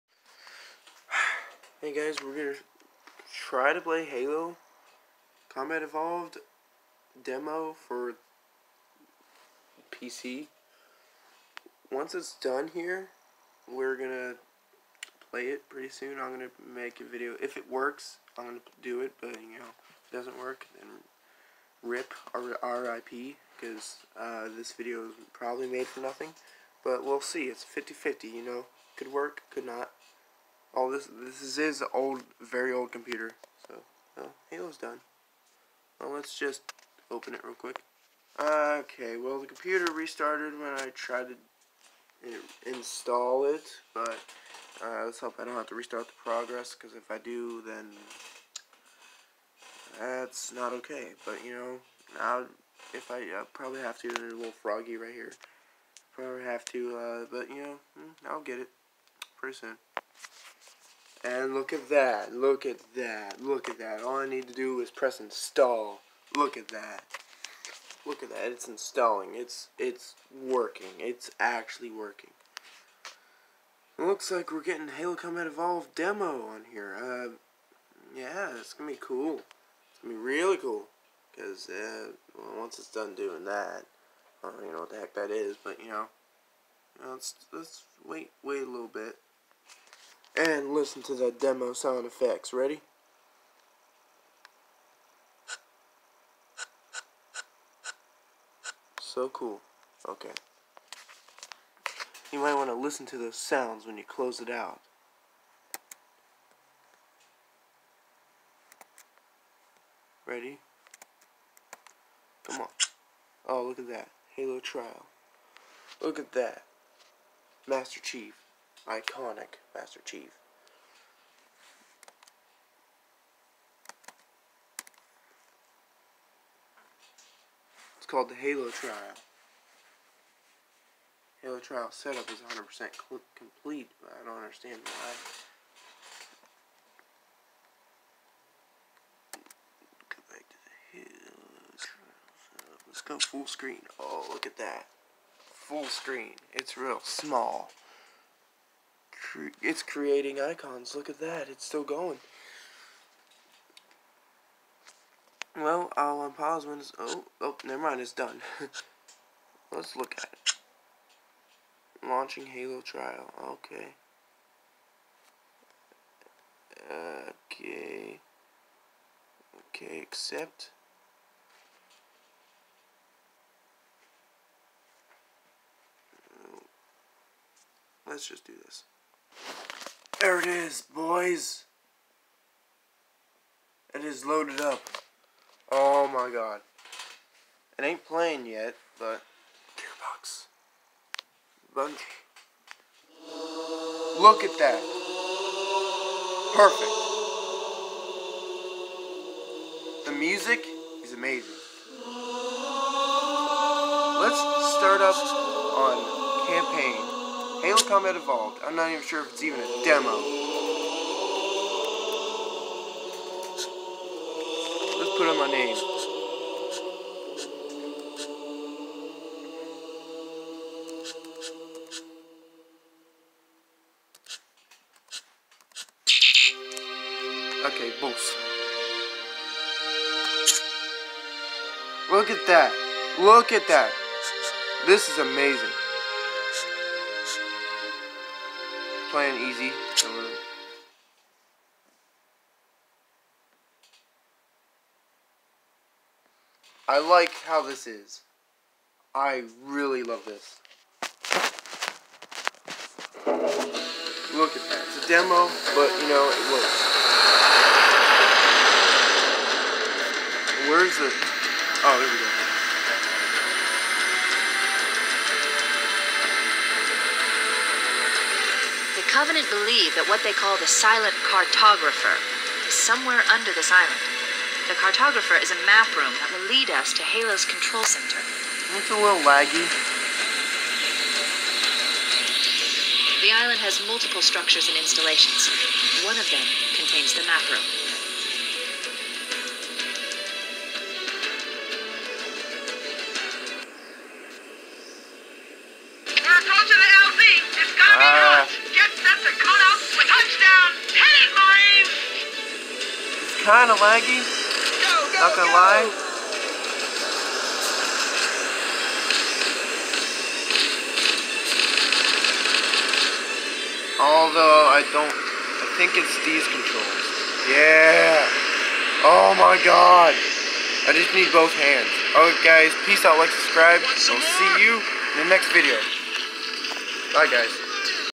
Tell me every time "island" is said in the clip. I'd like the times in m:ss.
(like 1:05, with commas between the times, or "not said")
4:33, 4:43.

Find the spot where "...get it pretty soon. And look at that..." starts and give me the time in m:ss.
0:58.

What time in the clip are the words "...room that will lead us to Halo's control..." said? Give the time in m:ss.
4:35.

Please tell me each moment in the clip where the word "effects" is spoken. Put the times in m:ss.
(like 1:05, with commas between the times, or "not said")
1:32.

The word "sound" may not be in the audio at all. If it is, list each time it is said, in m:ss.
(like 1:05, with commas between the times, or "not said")
1:31, 1:43.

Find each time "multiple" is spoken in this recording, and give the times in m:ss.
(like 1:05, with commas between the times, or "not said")
4:43.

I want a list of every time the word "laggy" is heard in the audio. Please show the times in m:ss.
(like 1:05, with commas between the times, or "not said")
4:39, 5:03.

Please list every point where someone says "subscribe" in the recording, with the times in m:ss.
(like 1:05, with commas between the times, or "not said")
5:23.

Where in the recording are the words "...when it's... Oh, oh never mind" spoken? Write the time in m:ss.
2:36.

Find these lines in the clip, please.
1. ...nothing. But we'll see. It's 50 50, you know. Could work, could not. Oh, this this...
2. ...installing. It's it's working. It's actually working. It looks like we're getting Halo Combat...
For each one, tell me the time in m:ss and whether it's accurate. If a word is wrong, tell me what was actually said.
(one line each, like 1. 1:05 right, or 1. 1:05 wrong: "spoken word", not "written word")
1. 0:26 right
2. 1:08 right.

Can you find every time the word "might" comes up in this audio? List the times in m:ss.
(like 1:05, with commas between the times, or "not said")
1:42.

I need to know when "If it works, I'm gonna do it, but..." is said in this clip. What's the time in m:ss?
0:17.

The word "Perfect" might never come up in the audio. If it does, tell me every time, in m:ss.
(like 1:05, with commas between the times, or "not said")
3:16.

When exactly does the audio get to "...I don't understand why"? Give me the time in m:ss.
2:14.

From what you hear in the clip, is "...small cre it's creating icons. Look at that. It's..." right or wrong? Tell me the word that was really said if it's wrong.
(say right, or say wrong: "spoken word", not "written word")
right.